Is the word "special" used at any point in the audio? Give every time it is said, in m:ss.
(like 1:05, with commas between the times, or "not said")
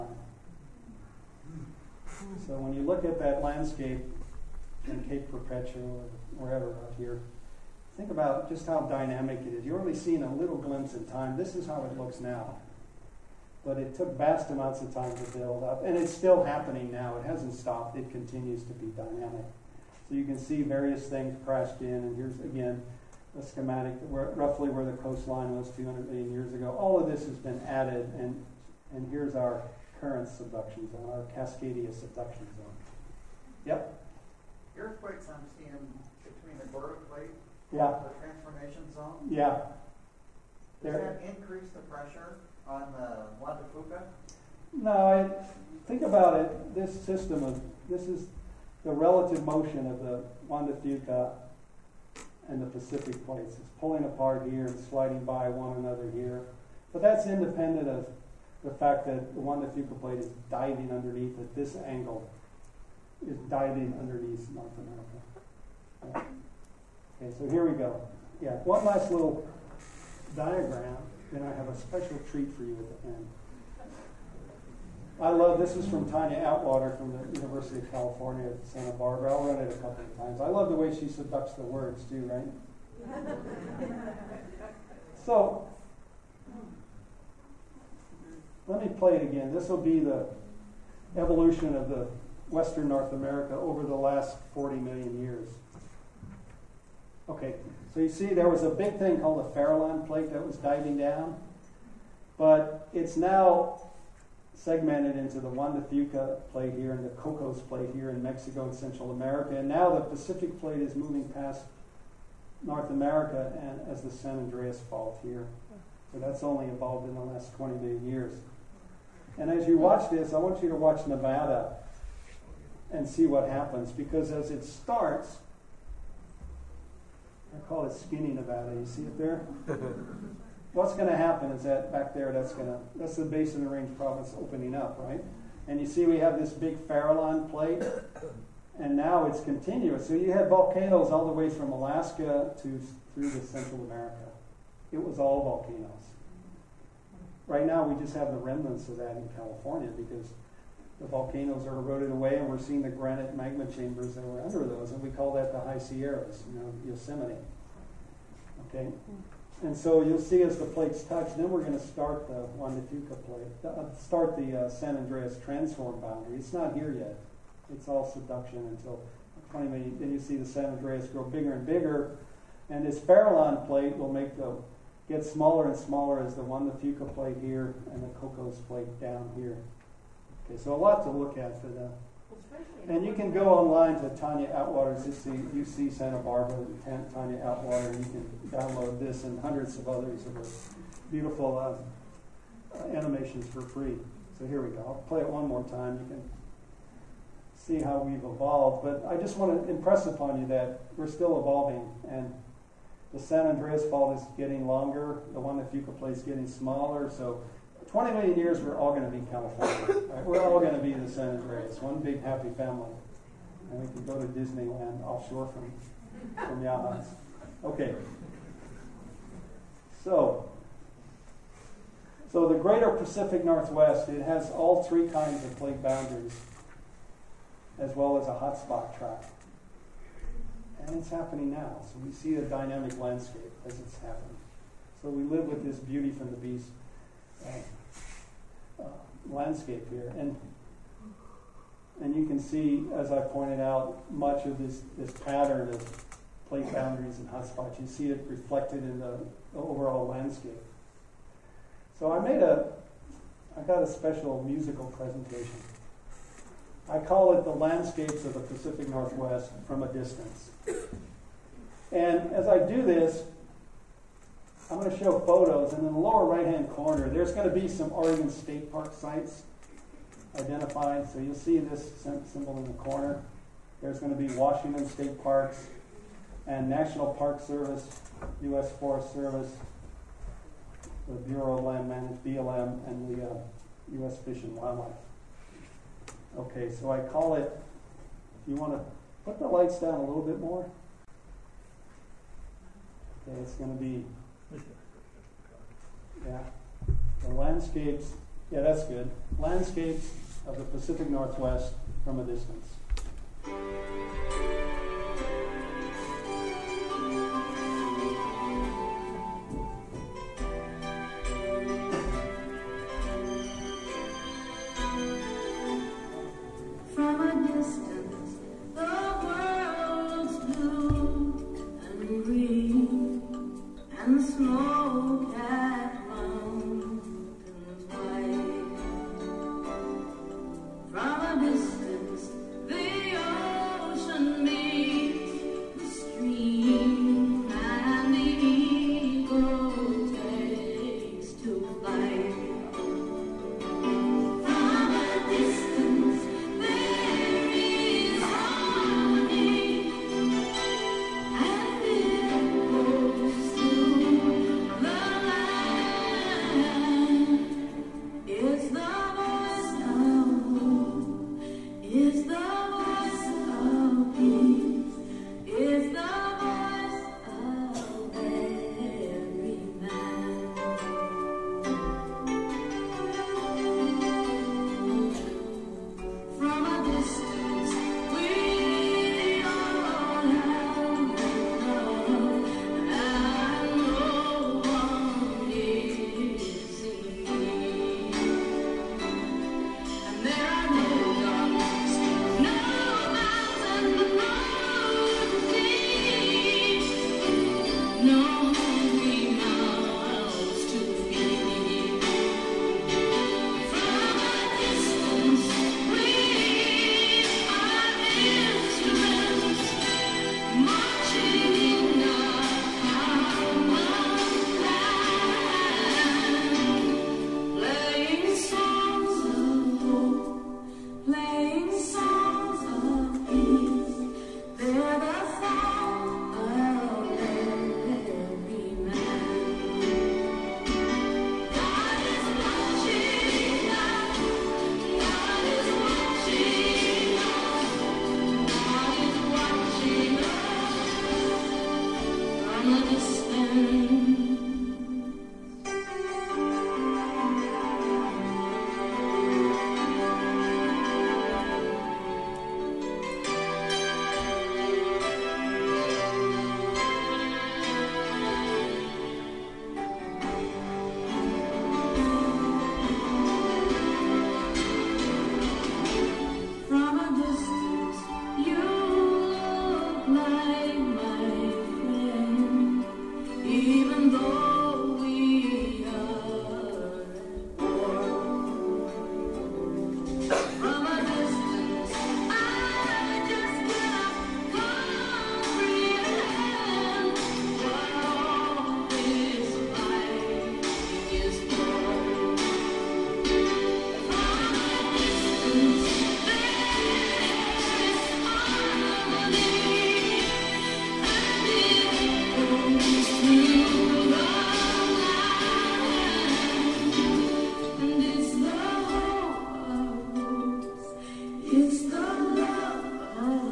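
1:11, 4:13.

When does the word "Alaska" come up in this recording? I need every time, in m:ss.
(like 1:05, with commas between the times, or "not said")
2:21.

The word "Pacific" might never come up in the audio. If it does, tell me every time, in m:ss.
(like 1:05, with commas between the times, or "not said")
0:52, 1:49, 3:42, 4:18, 5:00.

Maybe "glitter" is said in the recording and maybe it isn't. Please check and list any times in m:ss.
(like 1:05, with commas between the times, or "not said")
not said.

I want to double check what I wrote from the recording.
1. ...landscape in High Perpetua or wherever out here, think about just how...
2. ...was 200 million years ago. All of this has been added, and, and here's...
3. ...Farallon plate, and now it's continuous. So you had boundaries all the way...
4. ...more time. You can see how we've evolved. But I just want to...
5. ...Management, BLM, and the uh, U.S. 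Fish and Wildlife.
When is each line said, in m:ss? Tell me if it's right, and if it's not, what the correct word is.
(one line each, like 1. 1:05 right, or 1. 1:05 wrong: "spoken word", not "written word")
1. 0:03 wrong: "Cape", not "High"
2. 0:25 right
3. 2:16 wrong: "volcanoes", not "boundaries"
4. 3:15 right
5. 4:41 right.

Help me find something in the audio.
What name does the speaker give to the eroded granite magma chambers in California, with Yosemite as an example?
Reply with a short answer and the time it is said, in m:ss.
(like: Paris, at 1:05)
High Sierras, at 2:35.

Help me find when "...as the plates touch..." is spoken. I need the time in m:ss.
2:40.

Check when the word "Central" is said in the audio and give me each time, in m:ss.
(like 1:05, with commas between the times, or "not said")
1:48, 2:23.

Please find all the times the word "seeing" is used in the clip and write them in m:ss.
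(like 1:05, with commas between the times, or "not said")
0:09, 0:35, 2:32.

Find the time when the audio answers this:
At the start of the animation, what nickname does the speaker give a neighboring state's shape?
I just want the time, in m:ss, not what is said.
2:07.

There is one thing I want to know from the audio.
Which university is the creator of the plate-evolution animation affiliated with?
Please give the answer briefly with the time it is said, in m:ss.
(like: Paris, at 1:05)
University of California at Santa Barbara, at 1:17.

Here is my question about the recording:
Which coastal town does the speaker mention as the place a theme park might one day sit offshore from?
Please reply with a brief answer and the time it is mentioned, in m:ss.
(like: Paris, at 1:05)
Yachats, at 3:36.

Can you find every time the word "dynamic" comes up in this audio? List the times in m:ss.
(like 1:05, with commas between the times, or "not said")
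0:08, 0:18, 3:52.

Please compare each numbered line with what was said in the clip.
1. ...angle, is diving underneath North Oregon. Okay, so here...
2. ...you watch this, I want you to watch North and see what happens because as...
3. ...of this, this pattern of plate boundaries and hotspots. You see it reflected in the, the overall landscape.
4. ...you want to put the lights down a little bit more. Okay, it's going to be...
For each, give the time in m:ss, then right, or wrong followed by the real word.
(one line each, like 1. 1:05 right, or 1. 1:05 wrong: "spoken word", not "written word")
1. 1:01 wrong: "America", not "Oregon"
2. 1:59 wrong: "Nevada", not "North"
3. 4:04 right
4. 4:48 right.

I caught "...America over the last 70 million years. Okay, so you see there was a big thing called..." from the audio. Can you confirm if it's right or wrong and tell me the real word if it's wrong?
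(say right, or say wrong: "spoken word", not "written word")
wrong: "40", not "70".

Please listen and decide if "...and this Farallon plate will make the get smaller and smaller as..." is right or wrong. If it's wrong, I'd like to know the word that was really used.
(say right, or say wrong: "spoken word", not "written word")
right.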